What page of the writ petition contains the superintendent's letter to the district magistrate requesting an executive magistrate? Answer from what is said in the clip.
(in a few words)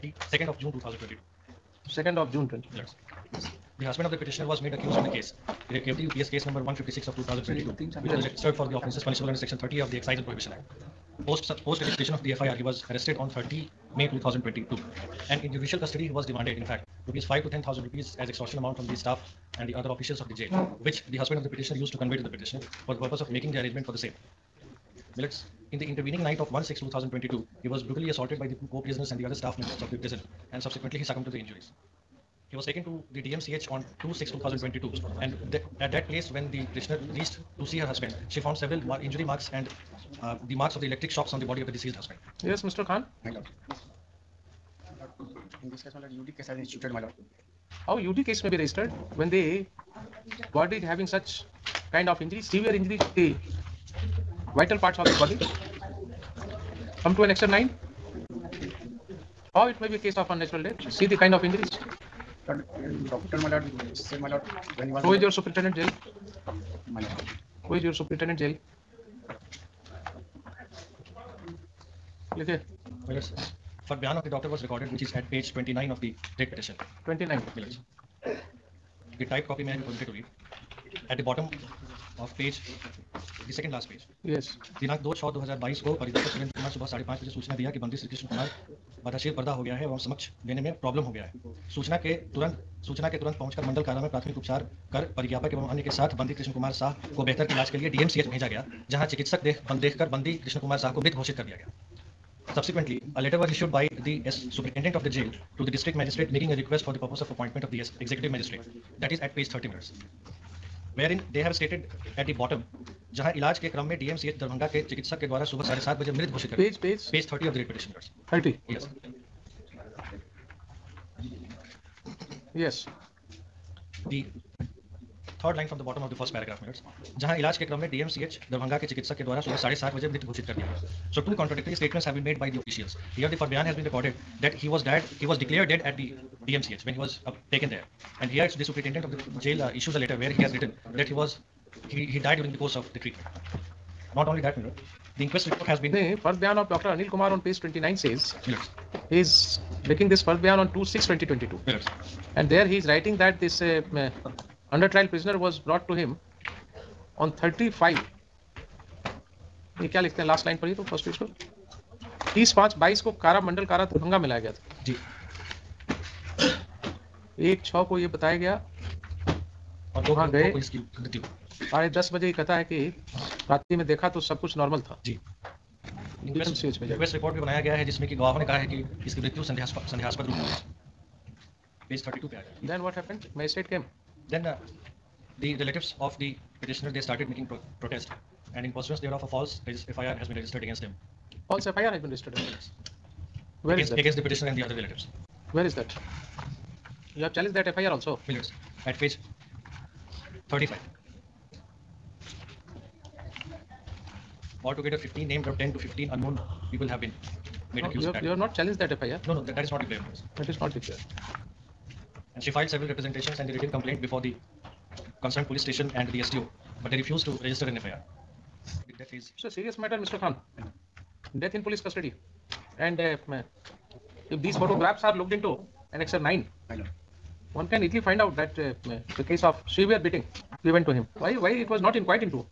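30.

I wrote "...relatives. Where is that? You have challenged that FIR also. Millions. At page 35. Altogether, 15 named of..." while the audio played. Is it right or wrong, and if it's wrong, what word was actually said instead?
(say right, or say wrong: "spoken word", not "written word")
right.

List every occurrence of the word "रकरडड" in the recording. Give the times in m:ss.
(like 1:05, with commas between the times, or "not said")
2:13.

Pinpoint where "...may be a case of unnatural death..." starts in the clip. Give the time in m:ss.
0:59.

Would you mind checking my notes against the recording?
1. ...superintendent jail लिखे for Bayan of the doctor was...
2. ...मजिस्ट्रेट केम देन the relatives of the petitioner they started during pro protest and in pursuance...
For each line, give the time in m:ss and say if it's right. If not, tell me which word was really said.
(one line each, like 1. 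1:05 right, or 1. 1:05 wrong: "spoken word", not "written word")
1. 1:07 right
2. 3:03 wrong: "making", not "during".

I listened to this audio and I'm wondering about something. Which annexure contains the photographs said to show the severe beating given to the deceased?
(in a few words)
Annexure 9.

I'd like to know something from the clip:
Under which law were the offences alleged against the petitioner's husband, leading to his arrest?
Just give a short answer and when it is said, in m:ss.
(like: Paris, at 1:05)
Excise and Prohibition Act, at 0:09.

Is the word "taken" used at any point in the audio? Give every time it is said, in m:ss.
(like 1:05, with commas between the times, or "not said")
0:32, 2:17.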